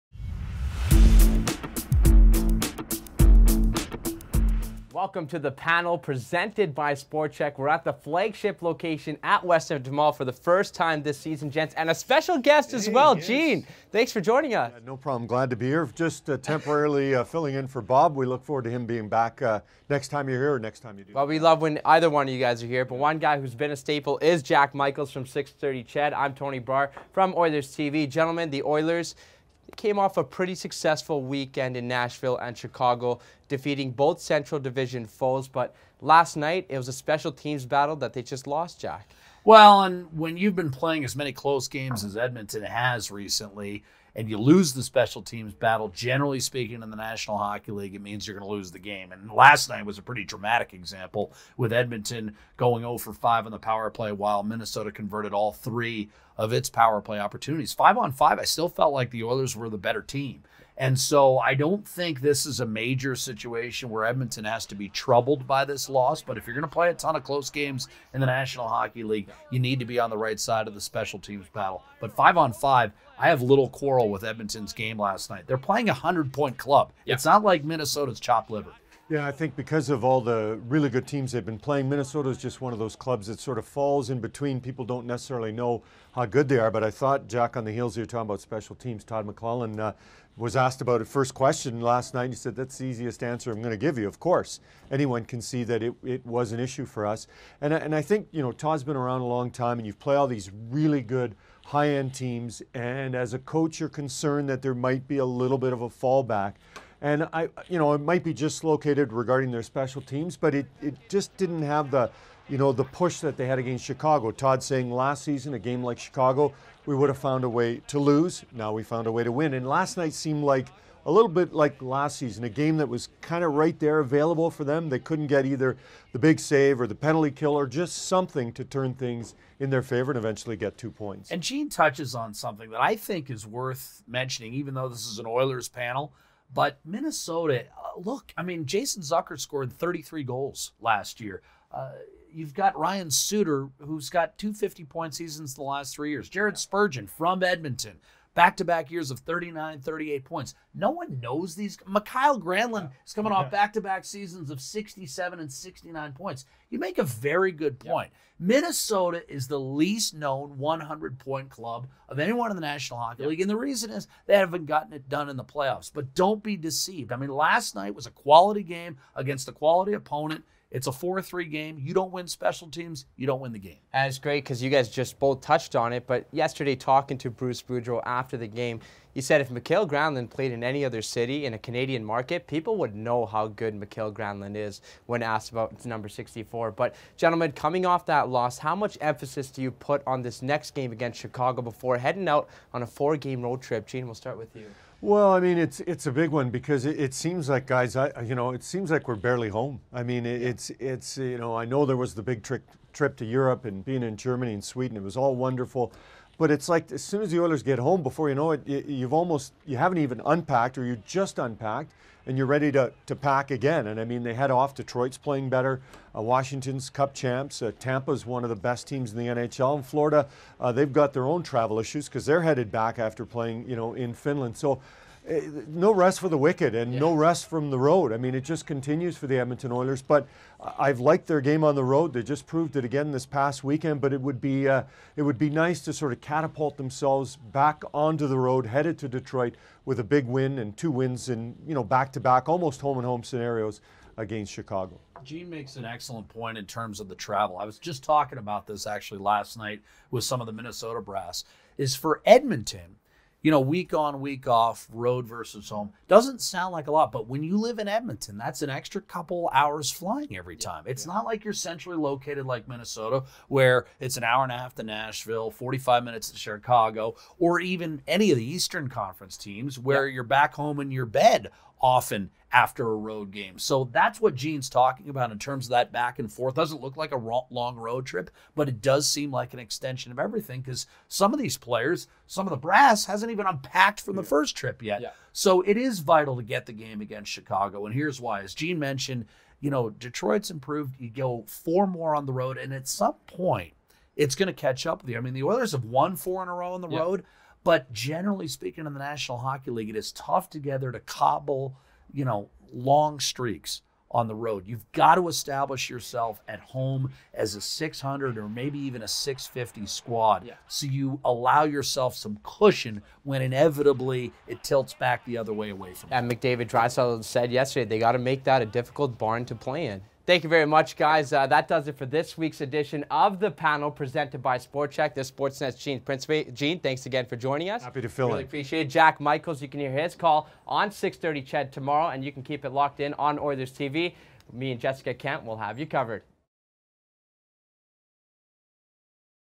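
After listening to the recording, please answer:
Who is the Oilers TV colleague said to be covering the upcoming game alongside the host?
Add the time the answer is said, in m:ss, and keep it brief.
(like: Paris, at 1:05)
Jessica Kent, at 5:34.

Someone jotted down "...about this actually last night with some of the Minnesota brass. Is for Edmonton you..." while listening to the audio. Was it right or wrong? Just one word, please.
right.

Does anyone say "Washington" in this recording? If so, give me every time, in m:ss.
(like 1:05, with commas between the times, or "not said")
3:36.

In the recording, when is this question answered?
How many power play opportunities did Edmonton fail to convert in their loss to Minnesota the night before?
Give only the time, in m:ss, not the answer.
0:52.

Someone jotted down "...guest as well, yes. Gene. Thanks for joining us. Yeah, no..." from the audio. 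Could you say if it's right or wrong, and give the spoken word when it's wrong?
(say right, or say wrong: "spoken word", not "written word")
right.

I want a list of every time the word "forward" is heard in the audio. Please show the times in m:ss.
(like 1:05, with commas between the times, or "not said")
0:18.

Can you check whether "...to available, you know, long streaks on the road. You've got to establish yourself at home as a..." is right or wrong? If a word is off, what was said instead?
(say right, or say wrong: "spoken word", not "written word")
wrong: "cobble", not "available".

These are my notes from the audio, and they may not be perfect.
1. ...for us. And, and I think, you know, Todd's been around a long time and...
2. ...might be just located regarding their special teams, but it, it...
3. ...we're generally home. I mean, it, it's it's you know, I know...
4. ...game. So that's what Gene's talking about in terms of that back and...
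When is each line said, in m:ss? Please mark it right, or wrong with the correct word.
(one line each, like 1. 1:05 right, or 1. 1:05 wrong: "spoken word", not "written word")
1. 1:36 right
2. 1:48 right
3. 3:19 wrong: "barely", not "generally"
4. 4:33 right.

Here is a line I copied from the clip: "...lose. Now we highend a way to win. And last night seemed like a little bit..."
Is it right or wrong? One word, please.
wrong.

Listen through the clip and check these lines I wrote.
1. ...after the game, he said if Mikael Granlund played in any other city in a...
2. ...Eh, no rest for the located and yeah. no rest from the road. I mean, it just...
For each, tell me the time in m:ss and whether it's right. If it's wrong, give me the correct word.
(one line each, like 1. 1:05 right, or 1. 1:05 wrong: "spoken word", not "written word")
1. 2:58 right
2. 3:45 wrong: "wicked", not "located".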